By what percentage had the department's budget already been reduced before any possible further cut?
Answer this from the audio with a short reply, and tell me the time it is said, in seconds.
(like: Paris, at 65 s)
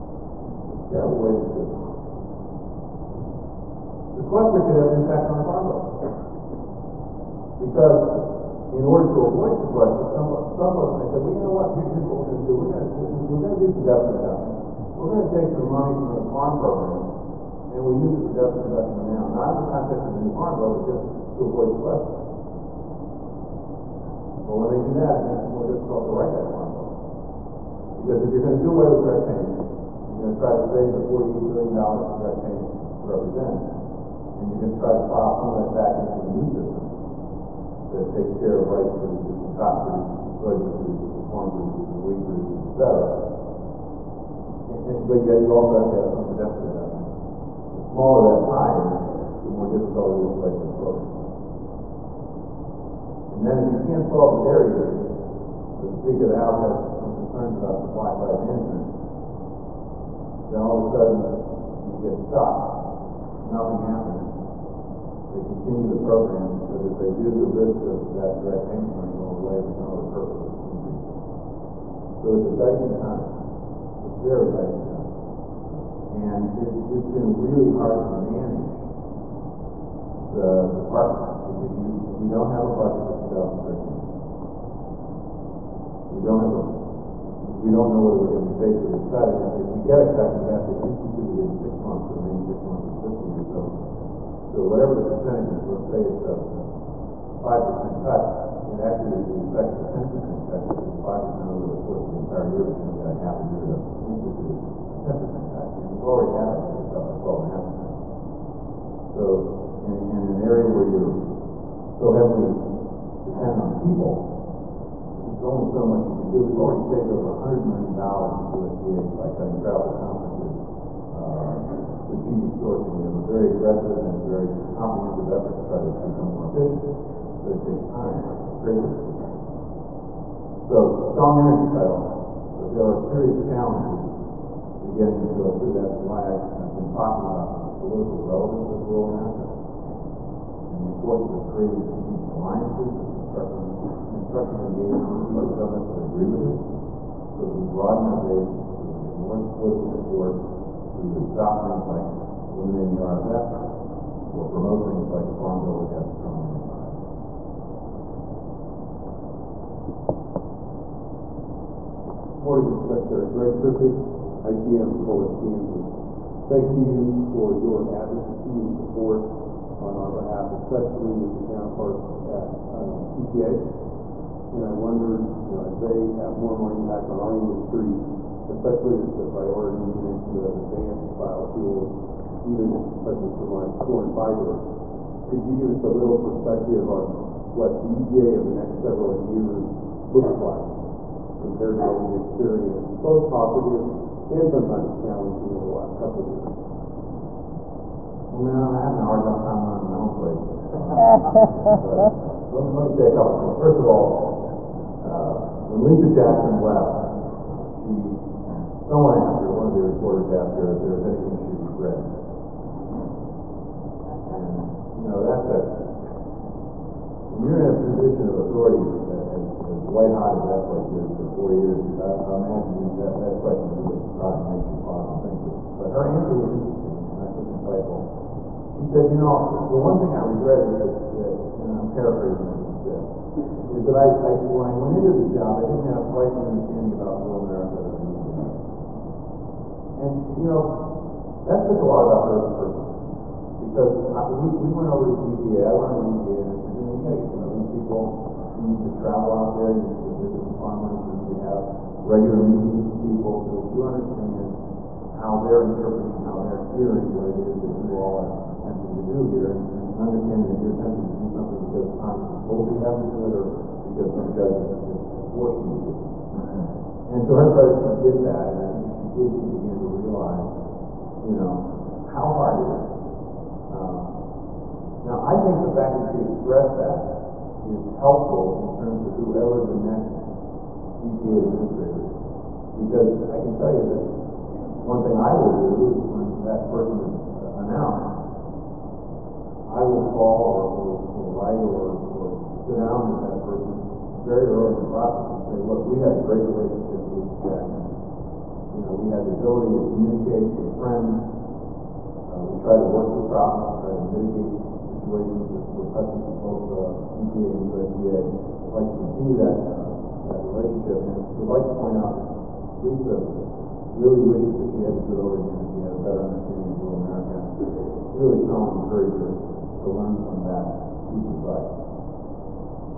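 12.5%, at 107 s.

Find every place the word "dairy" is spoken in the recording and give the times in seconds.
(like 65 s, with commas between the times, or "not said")
54 s.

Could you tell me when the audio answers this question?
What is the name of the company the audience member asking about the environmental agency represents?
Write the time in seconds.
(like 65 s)
164 s.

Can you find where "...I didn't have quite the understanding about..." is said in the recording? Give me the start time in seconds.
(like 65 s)
235 s.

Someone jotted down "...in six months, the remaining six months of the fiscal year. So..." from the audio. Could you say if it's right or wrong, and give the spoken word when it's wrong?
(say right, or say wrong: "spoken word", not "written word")
right.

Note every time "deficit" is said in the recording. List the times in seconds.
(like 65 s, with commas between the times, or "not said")
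13 s, 18 s, 46 s.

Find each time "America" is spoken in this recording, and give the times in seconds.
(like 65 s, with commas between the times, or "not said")
139 s, 317 s.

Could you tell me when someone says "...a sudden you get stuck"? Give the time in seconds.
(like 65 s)
60 s.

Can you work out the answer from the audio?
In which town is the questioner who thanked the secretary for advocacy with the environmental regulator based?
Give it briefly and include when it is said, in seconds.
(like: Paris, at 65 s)
Colwich, Kansas, at 165 s.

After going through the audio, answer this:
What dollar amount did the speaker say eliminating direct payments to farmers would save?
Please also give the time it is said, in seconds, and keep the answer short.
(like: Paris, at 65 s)
$48 billion, at 30 s.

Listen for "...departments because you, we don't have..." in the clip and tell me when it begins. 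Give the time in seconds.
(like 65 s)
80 s.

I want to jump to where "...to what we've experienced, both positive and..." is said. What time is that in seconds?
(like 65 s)
191 s.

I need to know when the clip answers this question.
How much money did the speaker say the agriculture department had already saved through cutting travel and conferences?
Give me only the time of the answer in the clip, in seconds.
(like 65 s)
117 s.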